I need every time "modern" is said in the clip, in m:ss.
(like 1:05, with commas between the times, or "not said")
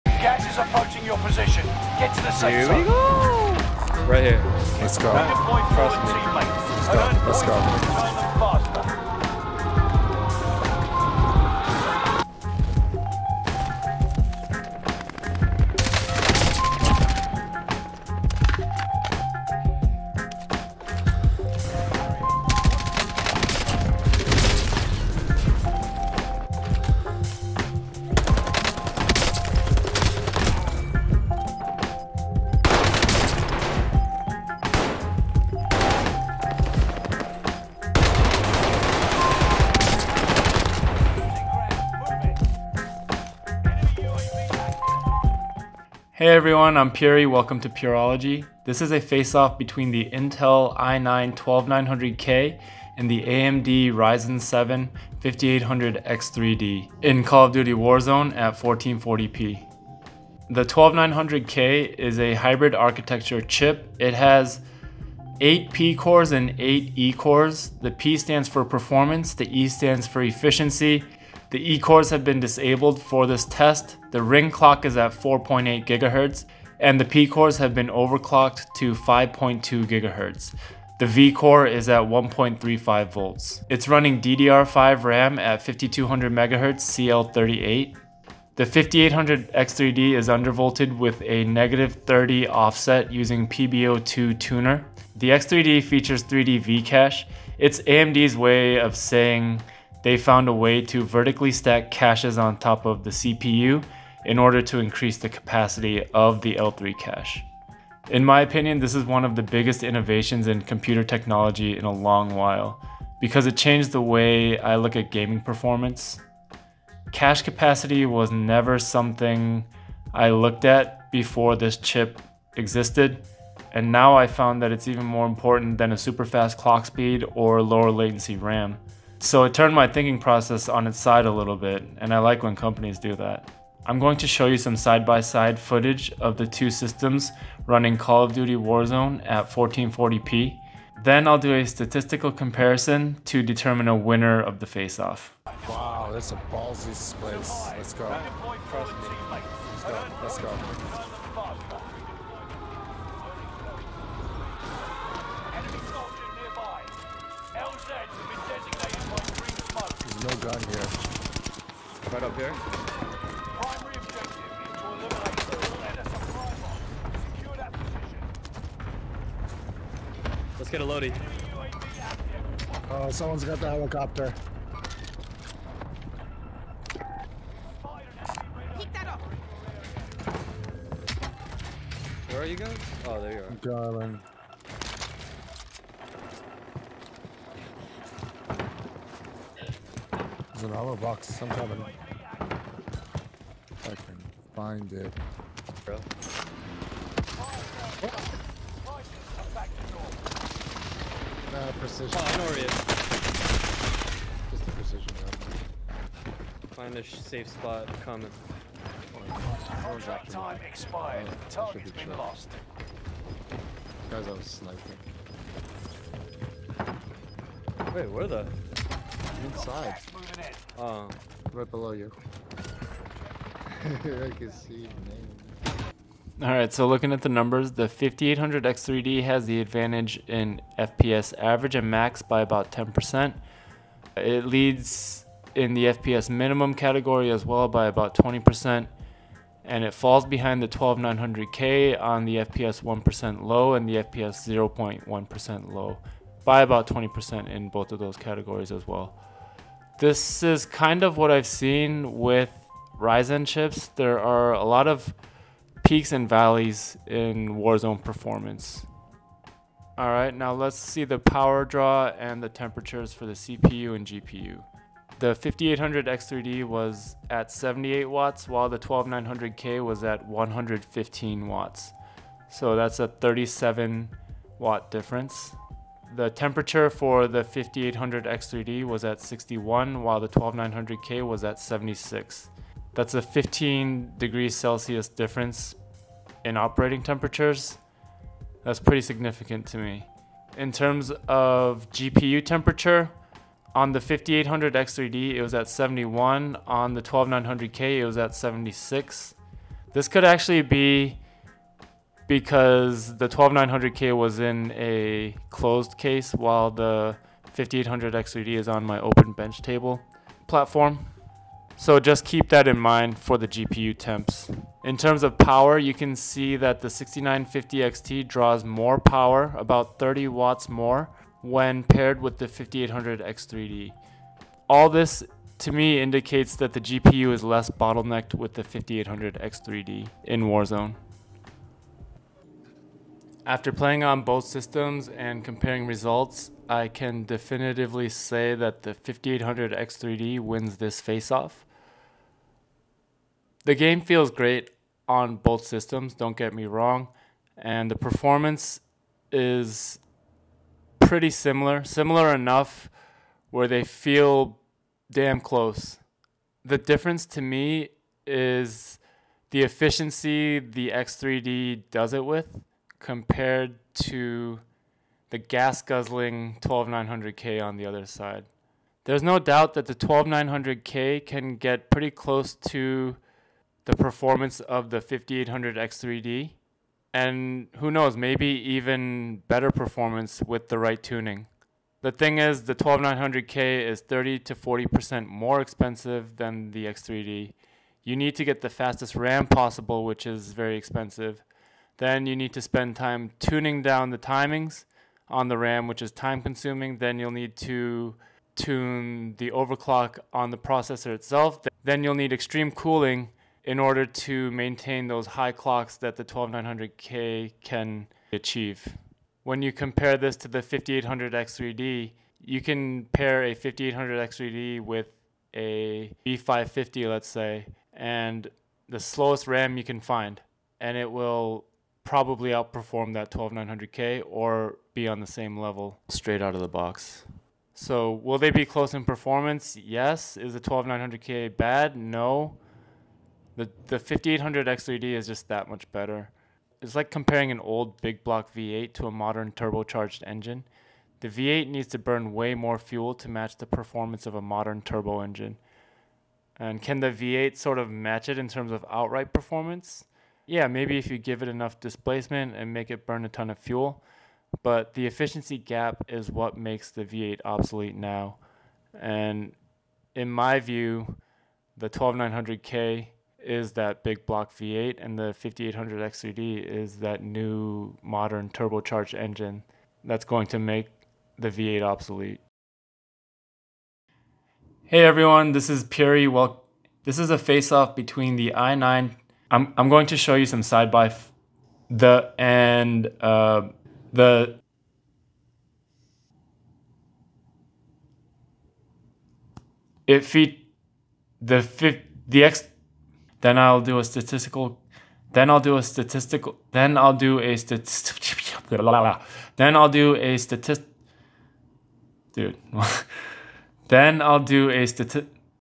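7:19, 7:24, 7:48.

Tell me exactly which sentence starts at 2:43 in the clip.
Primary objective is to eliminate the and supply box.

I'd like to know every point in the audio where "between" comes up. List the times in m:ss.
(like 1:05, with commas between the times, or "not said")
0:49, 7:57.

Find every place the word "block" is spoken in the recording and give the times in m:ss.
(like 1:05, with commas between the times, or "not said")
7:18, 7:44.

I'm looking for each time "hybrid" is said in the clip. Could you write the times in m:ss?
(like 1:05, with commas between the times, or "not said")
1:02.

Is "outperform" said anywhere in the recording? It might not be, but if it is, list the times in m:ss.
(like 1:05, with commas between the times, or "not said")
7:02.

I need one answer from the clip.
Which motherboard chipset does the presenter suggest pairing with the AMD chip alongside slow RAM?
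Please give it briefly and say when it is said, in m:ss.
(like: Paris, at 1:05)
B550, at 6:56.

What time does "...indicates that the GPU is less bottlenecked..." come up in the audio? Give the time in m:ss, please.
5:25.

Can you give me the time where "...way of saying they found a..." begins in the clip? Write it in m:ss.
1:38.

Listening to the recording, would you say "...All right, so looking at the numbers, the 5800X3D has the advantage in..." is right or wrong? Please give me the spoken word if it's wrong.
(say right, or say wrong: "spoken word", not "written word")
right.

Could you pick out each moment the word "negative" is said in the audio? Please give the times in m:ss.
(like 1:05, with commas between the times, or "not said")
1:31.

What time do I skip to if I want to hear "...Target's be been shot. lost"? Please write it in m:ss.
3:31.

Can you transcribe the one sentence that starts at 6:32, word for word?
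Then you need to spend time tuning down the timings on the RAM, which is time consuming.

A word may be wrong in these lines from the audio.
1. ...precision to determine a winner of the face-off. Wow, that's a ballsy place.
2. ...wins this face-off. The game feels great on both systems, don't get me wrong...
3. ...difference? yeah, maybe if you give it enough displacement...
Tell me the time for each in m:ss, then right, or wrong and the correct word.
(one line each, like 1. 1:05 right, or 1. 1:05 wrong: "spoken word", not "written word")
1. 2:22 wrong: "comparison", not "precision"
2. 5:40 right
3. 7:29 wrong: "performance", not "difference".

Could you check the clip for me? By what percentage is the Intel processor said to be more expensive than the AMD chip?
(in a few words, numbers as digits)
30 to 40%.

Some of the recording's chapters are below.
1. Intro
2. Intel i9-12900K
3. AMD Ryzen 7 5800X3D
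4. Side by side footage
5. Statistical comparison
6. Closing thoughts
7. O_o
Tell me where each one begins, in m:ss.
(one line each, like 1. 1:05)
1. 0:45
2. 1:00
3. 1:28
4. 2:25
5. 3:45
6. 5:32
7. 7:54.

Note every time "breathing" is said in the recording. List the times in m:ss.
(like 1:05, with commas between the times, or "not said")
not said.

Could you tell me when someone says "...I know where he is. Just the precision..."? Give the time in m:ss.
3:22.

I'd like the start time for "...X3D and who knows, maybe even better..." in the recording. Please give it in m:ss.
6:15.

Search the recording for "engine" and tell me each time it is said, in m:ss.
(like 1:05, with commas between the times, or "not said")
7:20, 7:25, 7:49.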